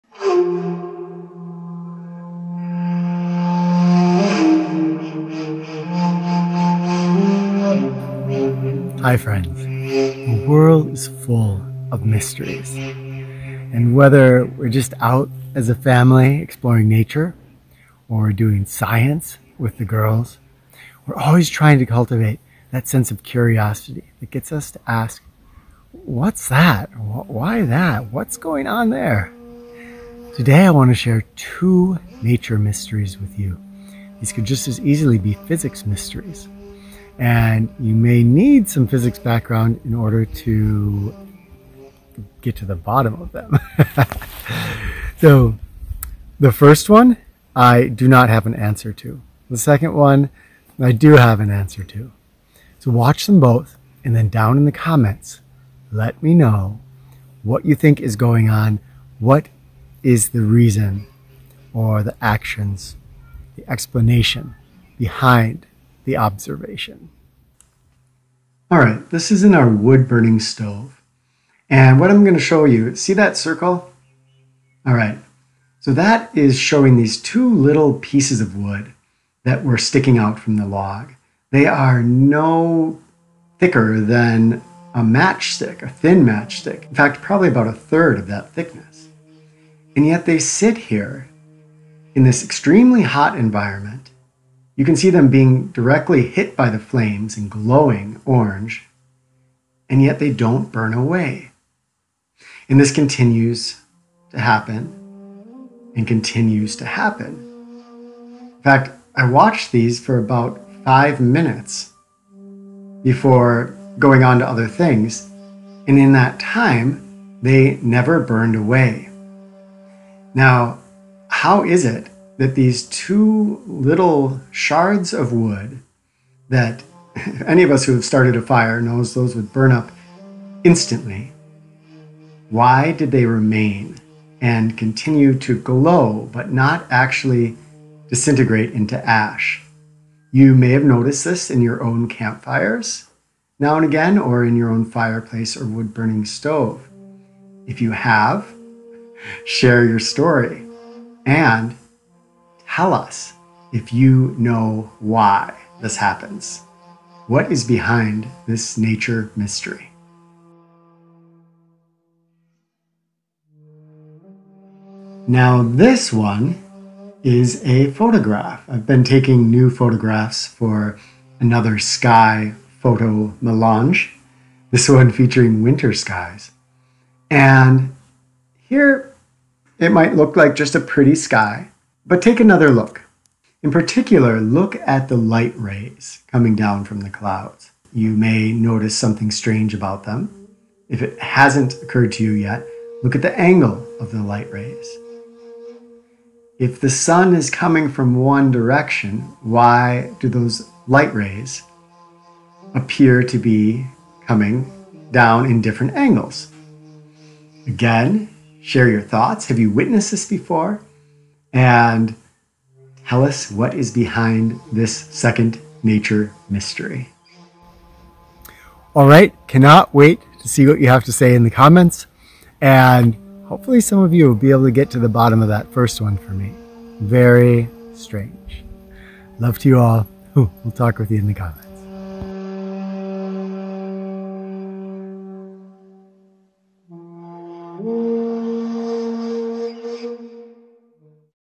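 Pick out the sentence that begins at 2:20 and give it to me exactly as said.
You may have noticed this in your own campfires now and again or in your own fireplace or wood burning stove.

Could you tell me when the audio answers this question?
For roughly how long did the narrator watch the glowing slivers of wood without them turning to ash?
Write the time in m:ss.
1:50.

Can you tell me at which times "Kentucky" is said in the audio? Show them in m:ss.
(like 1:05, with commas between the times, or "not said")
not said.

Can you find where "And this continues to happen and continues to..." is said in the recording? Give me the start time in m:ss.
1:42.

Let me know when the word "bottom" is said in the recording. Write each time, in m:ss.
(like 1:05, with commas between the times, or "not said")
0:42, 3:45.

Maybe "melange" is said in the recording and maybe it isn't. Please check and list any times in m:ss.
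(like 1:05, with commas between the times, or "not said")
2:53.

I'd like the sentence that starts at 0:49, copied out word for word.
The second one, I do have an answer to.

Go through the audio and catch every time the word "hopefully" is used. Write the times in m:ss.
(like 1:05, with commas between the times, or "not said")
3:43.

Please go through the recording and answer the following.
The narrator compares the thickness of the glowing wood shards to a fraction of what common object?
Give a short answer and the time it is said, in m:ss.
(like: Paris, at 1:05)
a thin matchstick, at 1:25.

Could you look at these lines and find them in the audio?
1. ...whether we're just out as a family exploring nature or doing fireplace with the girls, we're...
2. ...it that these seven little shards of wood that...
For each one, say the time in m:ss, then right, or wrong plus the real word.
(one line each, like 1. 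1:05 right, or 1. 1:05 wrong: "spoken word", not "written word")
1. 0:13 wrong: "science", not "fireplace"
2. 2:01 wrong: "two", not "seven".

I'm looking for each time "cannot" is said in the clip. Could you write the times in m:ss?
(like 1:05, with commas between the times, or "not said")
3:39.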